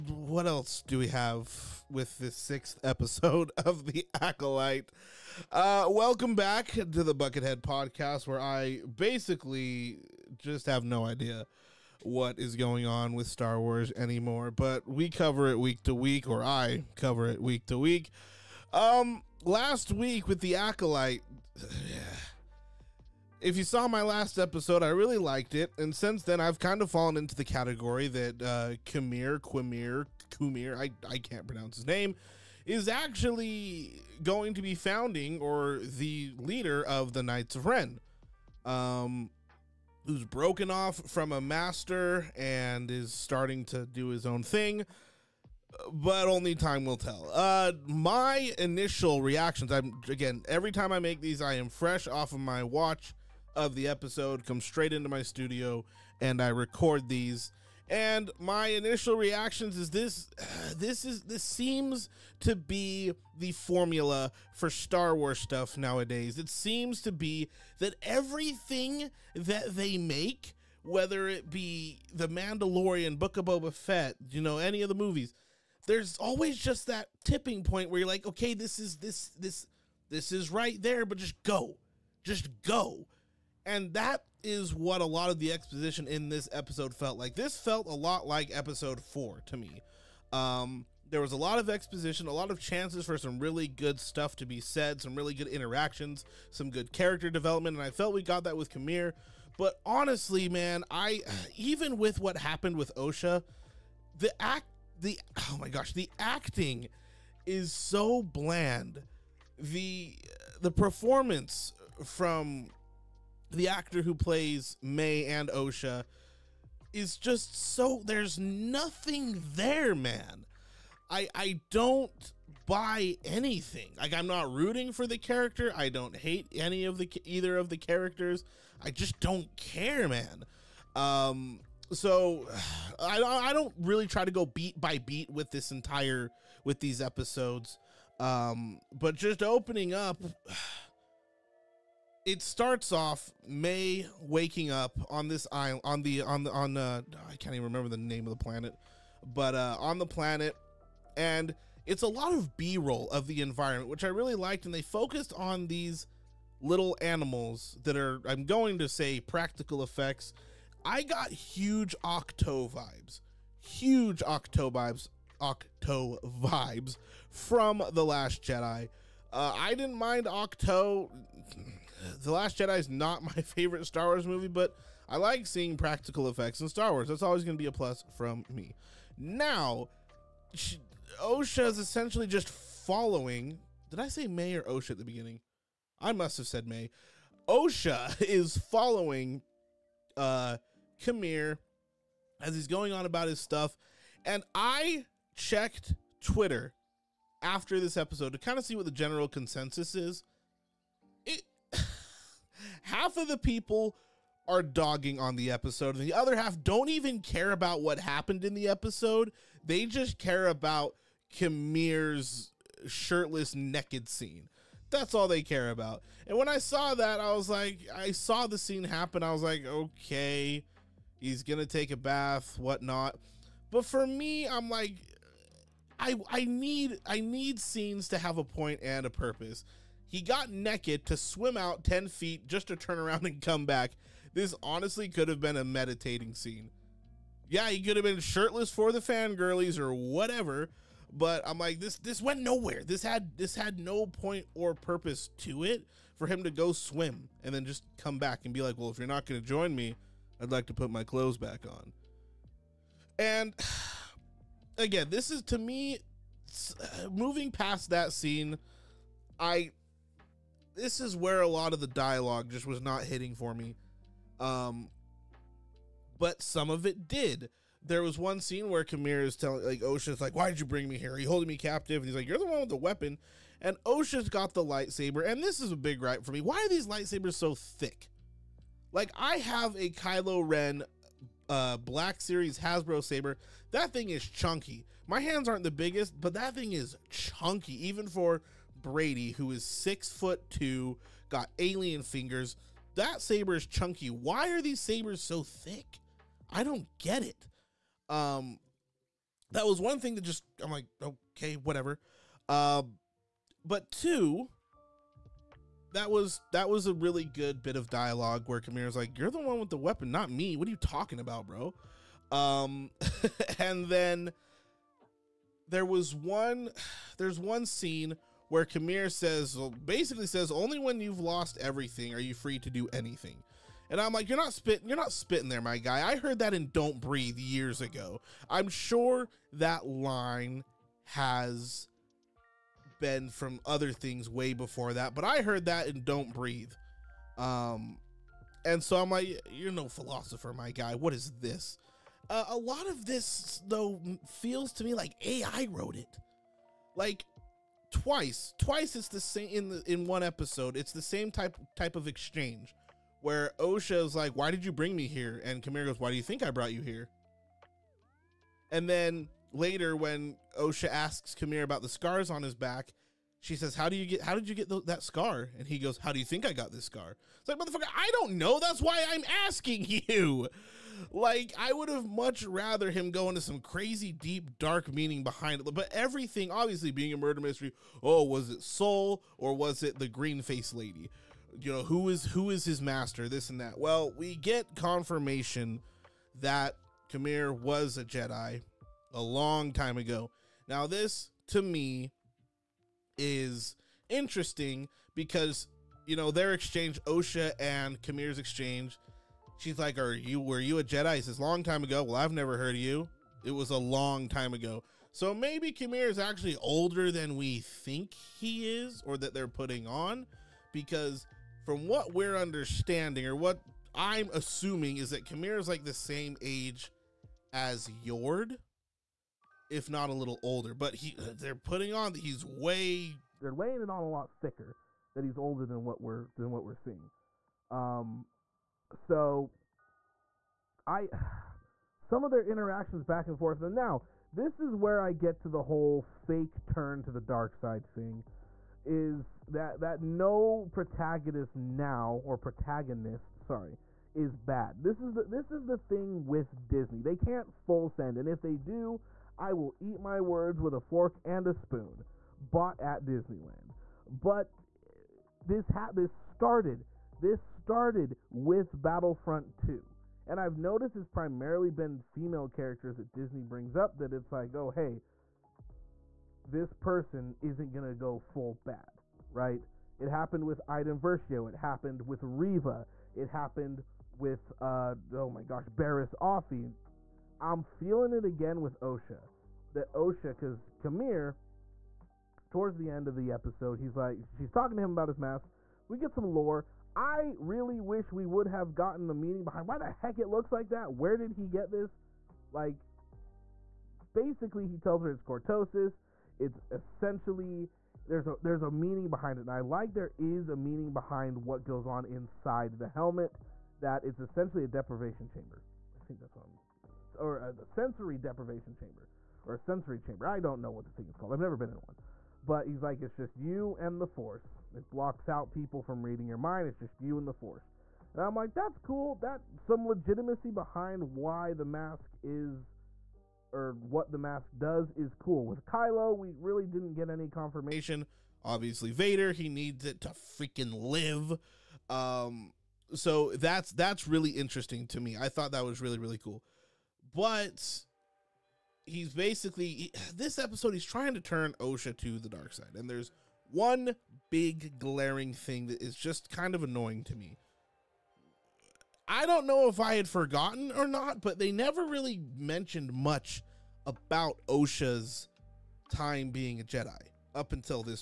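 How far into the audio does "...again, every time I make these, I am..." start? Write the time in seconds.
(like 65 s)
50 s.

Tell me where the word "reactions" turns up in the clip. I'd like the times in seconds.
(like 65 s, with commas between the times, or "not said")
49 s, 59 s.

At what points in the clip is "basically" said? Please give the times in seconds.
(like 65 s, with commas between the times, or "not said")
8 s, 319 s, 494 s, 539 s.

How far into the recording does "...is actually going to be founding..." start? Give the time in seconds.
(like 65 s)
32 s.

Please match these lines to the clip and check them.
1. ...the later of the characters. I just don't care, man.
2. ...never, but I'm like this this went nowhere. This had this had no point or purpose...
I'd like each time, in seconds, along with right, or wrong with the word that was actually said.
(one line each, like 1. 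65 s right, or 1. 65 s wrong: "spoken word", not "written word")
1. 126 s wrong: "either", not "later"
2. 239 s wrong: "whatever", not "never".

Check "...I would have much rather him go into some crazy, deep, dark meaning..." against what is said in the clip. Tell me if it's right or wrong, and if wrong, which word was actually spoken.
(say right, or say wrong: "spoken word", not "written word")
right.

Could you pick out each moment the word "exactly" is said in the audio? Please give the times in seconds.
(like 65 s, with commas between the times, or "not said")
not said.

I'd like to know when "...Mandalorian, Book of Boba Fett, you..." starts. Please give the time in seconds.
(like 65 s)
72 s.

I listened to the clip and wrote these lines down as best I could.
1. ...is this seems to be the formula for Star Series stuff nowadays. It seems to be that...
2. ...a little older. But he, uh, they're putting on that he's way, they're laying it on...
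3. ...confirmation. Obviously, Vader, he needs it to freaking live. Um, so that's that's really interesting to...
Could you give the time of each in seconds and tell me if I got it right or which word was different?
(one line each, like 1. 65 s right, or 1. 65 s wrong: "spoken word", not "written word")
1. 61 s wrong: "Wars", not "Series"
2. 420 s right
3. 527 s right.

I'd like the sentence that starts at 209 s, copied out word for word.
They just care about Kimir's shirtless, naked scene.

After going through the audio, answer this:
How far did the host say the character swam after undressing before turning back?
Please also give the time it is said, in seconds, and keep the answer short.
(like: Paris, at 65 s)
10 feet, at 231 s.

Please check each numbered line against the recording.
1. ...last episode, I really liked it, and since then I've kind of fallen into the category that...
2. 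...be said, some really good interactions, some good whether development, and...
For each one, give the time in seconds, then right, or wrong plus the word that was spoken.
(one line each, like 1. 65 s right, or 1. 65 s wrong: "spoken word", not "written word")
1. 24 s right
2. 94 s wrong: "character", not "whether".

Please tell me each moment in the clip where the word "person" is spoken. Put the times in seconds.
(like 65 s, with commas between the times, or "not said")
466 s.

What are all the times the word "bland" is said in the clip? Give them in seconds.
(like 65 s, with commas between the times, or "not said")
108 s.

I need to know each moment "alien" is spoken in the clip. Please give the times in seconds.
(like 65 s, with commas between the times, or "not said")
291 s.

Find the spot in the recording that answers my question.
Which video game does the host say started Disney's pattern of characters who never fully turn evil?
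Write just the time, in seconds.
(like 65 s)
458 s.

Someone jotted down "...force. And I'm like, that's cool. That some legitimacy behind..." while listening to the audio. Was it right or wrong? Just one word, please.
right.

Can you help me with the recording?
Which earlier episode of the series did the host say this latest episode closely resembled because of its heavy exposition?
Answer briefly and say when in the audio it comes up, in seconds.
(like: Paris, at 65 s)
Episode 4, at 88 s.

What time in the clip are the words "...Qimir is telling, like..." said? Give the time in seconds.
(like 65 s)
268 s.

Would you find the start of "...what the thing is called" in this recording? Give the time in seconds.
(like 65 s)
510 s.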